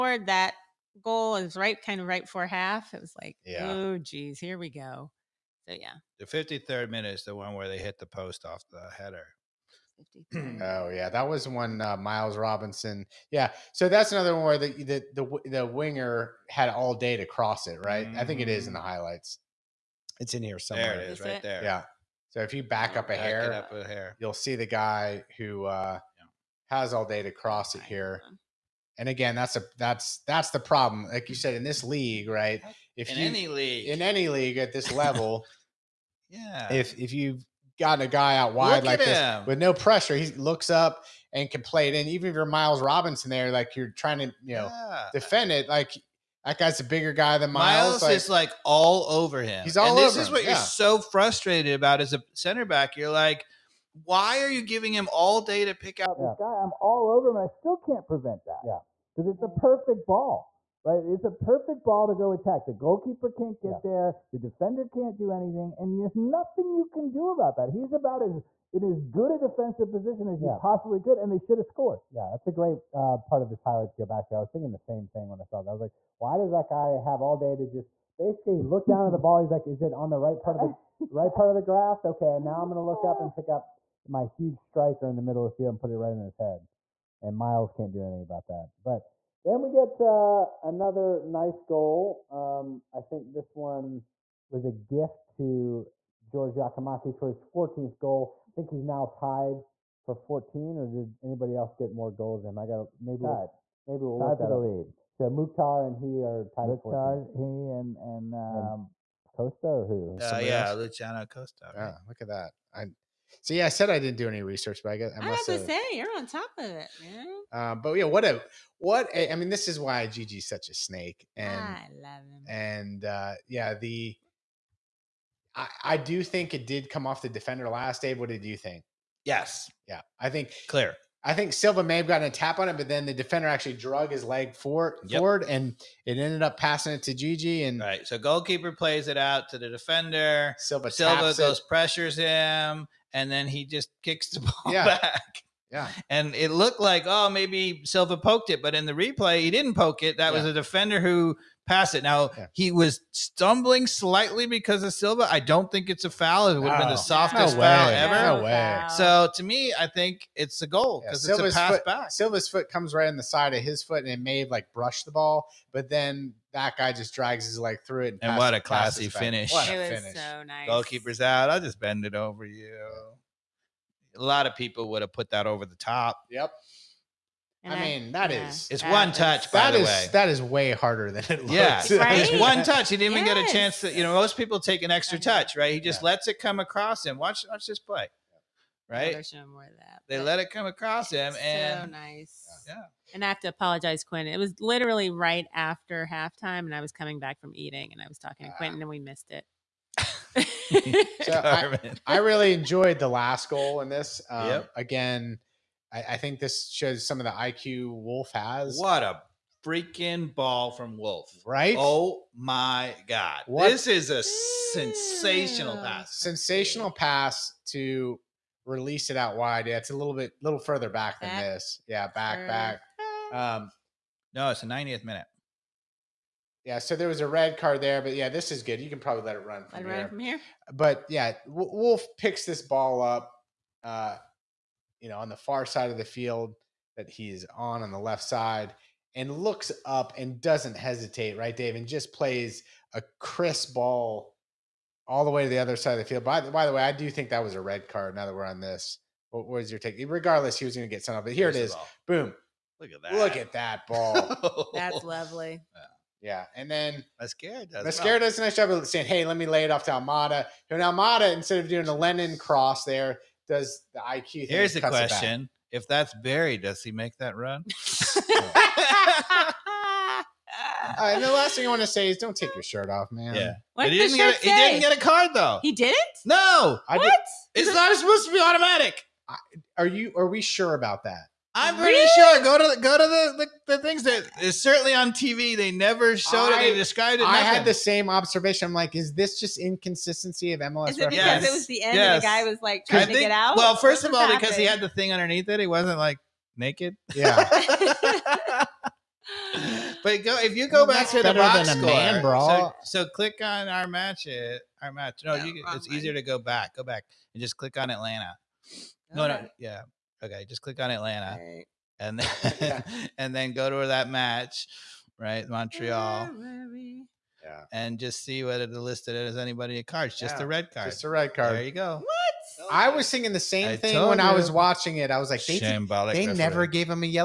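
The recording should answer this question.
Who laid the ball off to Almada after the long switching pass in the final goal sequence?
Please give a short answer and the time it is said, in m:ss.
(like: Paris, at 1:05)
Mosquera, at 4:17.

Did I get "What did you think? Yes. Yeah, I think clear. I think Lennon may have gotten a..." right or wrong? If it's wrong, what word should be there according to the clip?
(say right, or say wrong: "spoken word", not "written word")
wrong: "Silva", not "Lennon".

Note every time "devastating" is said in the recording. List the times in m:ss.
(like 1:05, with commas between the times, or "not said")
not said.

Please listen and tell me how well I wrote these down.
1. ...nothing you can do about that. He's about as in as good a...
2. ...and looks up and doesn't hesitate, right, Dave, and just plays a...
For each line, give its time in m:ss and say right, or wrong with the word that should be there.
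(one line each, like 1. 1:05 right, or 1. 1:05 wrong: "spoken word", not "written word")
1. 1:06 right
2. 3:59 right.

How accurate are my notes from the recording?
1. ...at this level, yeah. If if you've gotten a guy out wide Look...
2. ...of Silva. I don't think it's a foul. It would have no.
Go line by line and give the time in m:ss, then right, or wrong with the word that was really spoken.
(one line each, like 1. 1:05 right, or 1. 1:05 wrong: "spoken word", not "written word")
1. 0:34 right
2. 2:34 right.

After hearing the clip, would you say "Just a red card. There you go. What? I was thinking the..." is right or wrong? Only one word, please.
right.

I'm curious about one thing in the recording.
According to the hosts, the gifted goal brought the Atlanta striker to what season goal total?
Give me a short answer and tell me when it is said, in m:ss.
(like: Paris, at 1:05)
14, at 1:37.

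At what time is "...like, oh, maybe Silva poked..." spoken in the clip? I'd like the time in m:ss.
2:26.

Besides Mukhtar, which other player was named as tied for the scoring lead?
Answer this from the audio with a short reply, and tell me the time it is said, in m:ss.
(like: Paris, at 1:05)
Luciano Costa, at 1:50.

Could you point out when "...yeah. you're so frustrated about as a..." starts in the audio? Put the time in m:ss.
0:50.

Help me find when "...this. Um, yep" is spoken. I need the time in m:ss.
3:23.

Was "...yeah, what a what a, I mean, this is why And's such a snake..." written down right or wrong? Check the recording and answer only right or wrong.
wrong.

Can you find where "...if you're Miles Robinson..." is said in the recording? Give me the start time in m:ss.
0:42.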